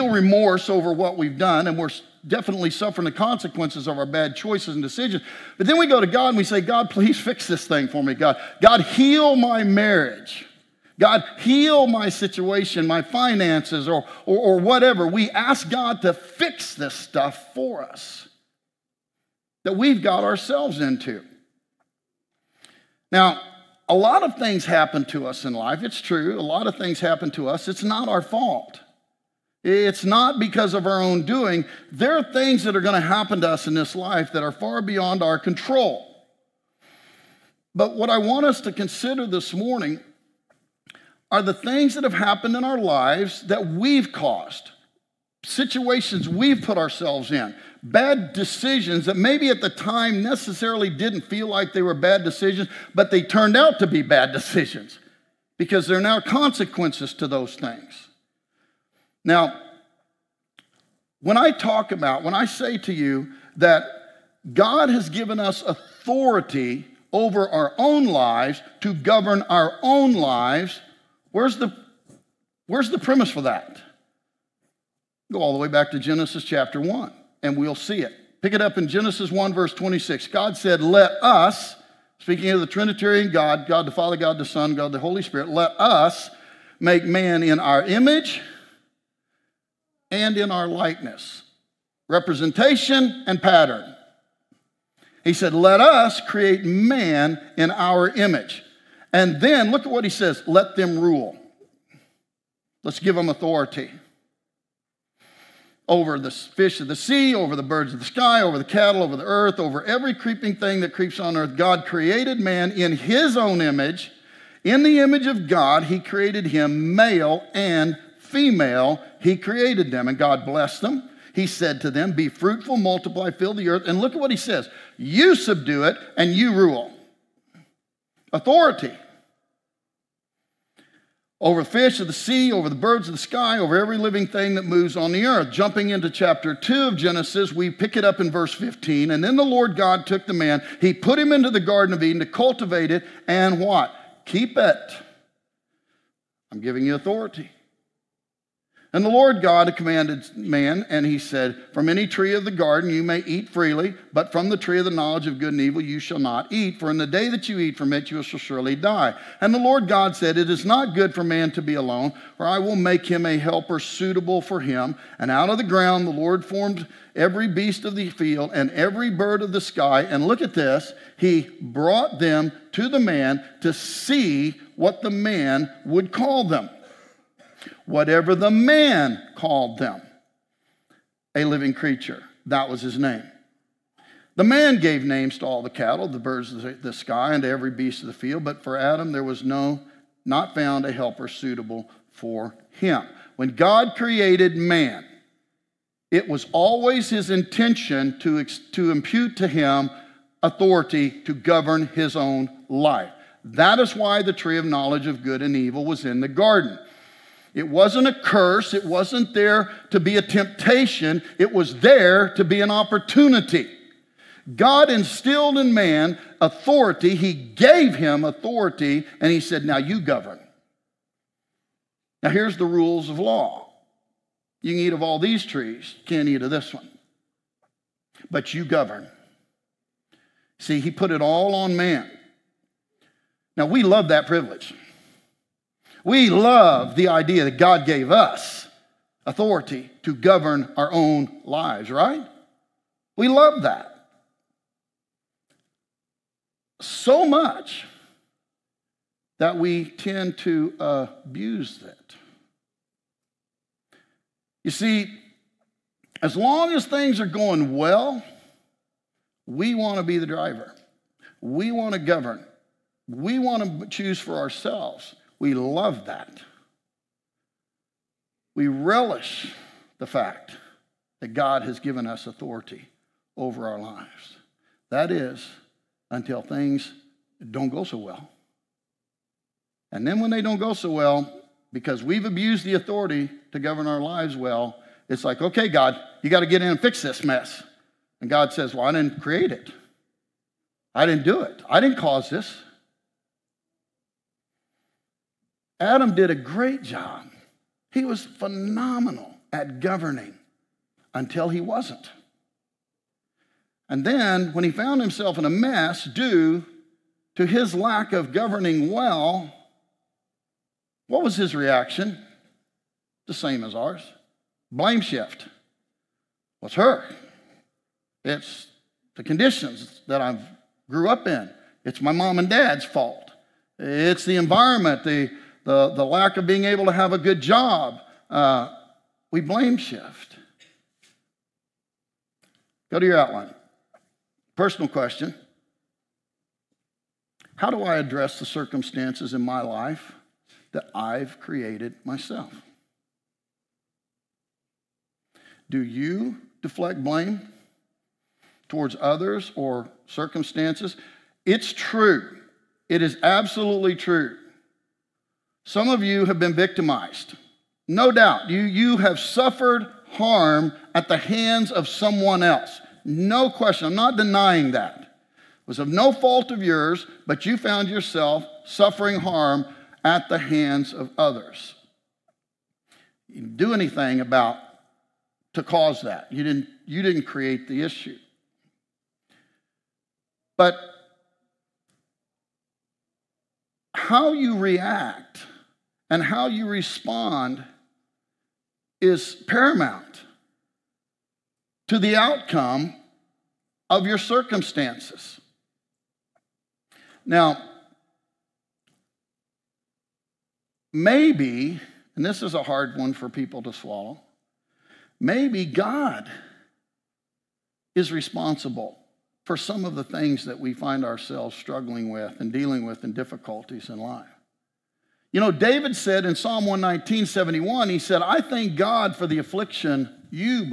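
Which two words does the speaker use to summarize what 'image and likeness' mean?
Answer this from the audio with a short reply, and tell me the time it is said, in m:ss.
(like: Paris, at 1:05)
Representation and pattern, at 1:32.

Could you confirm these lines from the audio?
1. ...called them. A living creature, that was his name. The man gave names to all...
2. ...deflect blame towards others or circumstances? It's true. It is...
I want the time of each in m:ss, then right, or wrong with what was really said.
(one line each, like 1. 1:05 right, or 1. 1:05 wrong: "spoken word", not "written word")
1. 2:59 right
2. 5:46 right.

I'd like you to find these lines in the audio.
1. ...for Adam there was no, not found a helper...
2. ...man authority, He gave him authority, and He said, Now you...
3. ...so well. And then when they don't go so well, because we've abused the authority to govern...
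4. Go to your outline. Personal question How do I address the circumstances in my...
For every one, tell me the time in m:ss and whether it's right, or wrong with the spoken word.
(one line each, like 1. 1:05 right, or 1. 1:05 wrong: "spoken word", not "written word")
1. 3:08 right
2. 3:35 right
3. 4:37 right
4. 5:32 right.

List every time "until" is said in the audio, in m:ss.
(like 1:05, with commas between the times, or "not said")
4:36, 5:01.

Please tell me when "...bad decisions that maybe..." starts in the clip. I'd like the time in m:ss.
0:47.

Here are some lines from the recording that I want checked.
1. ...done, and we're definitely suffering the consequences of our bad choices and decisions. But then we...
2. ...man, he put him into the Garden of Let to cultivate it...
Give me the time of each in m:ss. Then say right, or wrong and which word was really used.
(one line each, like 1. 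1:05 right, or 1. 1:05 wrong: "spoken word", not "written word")
1. 0:01 right
2. 2:20 wrong: "Eden", not "Let".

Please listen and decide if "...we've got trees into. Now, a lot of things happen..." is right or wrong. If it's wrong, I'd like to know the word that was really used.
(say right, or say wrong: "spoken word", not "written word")
wrong: "ourselves", not "trees".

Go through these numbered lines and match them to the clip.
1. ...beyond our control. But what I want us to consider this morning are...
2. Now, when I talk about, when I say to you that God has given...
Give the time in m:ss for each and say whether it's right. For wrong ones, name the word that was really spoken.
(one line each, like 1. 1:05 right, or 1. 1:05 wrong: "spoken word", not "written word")
1. 0:34 right
2. 0:59 right.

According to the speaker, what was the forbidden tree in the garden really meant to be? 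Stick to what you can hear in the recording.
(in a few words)
An opportunity.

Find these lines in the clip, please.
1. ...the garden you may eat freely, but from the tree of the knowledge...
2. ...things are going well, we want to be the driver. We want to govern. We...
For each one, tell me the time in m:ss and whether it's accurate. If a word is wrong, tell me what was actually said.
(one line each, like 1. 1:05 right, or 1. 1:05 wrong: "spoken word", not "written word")
1. 2:32 right
2. 4:16 right.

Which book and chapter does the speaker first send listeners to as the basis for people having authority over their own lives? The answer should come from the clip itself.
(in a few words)
Genesis 1.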